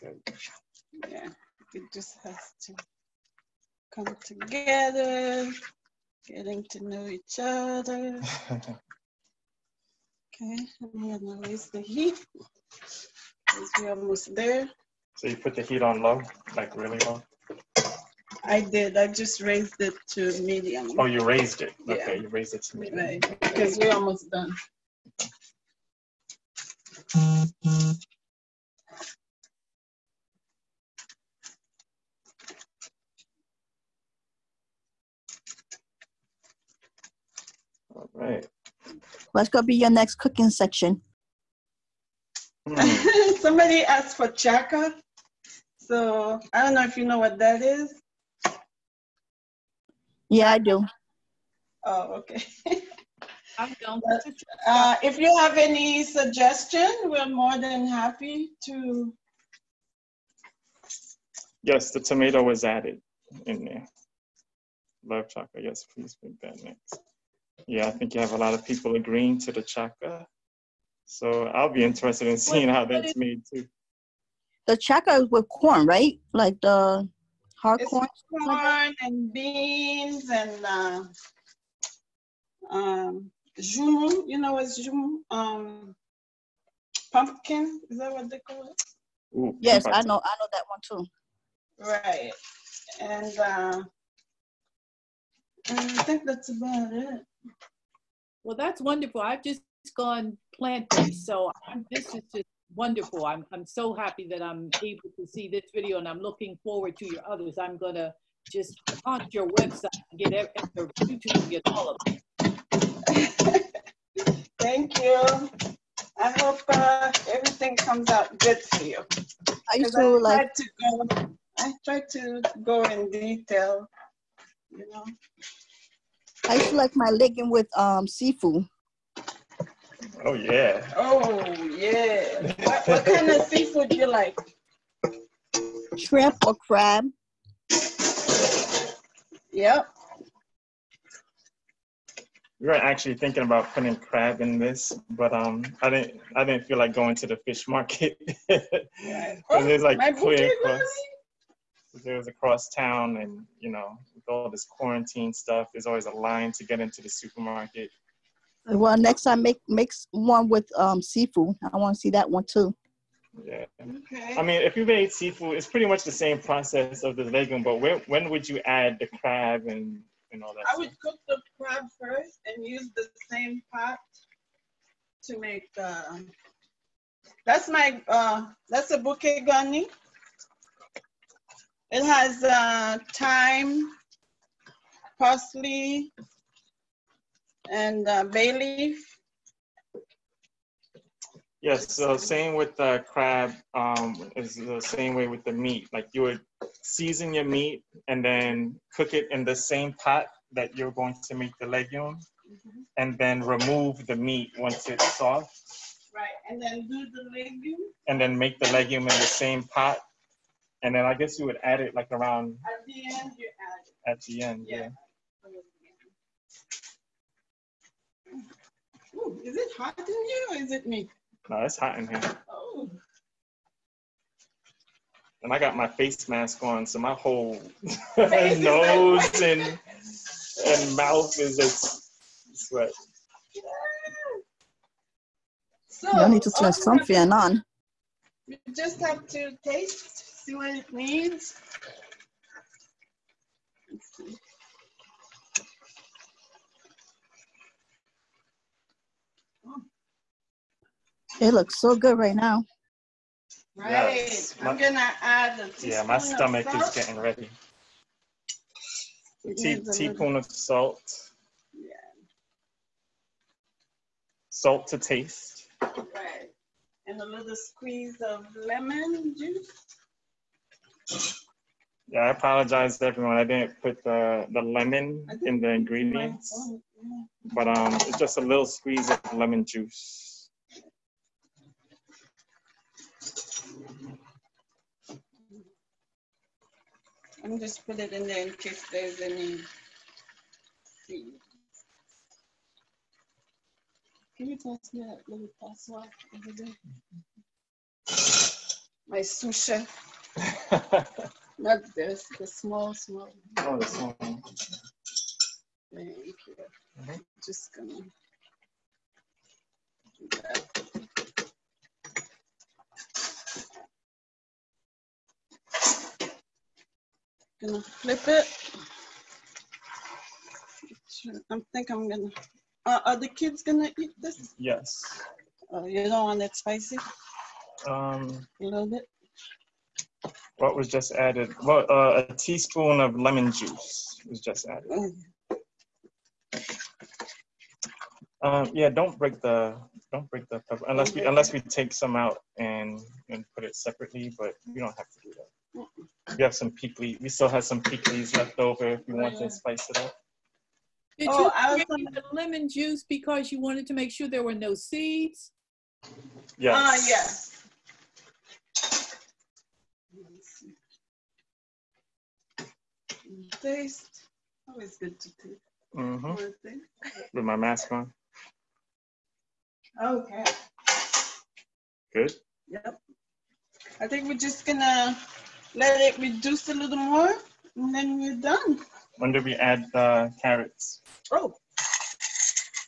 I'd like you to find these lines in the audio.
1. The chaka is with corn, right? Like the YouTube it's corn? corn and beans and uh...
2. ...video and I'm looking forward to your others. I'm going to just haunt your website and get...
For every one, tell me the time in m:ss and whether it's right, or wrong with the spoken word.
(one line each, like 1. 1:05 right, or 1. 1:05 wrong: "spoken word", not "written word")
1. 1:14 wrong: "Hard", not "YouTube"
2. 1:45 right.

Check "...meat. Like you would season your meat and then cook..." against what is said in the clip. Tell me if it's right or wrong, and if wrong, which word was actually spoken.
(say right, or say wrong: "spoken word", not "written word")
right.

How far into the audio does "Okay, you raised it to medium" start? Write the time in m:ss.
0:21.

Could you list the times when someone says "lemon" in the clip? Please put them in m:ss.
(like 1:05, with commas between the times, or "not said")
4:28, 4:34, 4:39, 5:33, 5:52.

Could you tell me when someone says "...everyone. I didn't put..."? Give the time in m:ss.
4:33.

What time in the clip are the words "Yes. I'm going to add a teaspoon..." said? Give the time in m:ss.
4:14.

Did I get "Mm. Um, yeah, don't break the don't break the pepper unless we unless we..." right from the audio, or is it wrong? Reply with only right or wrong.
right.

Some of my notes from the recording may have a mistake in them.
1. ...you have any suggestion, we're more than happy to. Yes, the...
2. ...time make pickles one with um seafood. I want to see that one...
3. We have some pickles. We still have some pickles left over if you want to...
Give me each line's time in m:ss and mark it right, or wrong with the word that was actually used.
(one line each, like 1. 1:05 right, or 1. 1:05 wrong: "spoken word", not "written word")
1. 0:55 right
2. 2:39 wrong: "makes", not "pickles"
3. 5:45 right.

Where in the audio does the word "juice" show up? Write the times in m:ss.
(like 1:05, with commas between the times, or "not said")
4:29, 4:39, 5:33, 5:52.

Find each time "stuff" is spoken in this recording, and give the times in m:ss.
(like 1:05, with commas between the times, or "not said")
2:35, 2:50.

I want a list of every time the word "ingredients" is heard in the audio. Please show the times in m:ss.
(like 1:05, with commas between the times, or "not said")
4:35.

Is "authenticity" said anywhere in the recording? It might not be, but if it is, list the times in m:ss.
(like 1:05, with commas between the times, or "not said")
not said.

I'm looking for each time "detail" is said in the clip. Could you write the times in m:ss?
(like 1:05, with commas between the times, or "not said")
2:03.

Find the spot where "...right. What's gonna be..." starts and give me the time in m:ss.
0:38.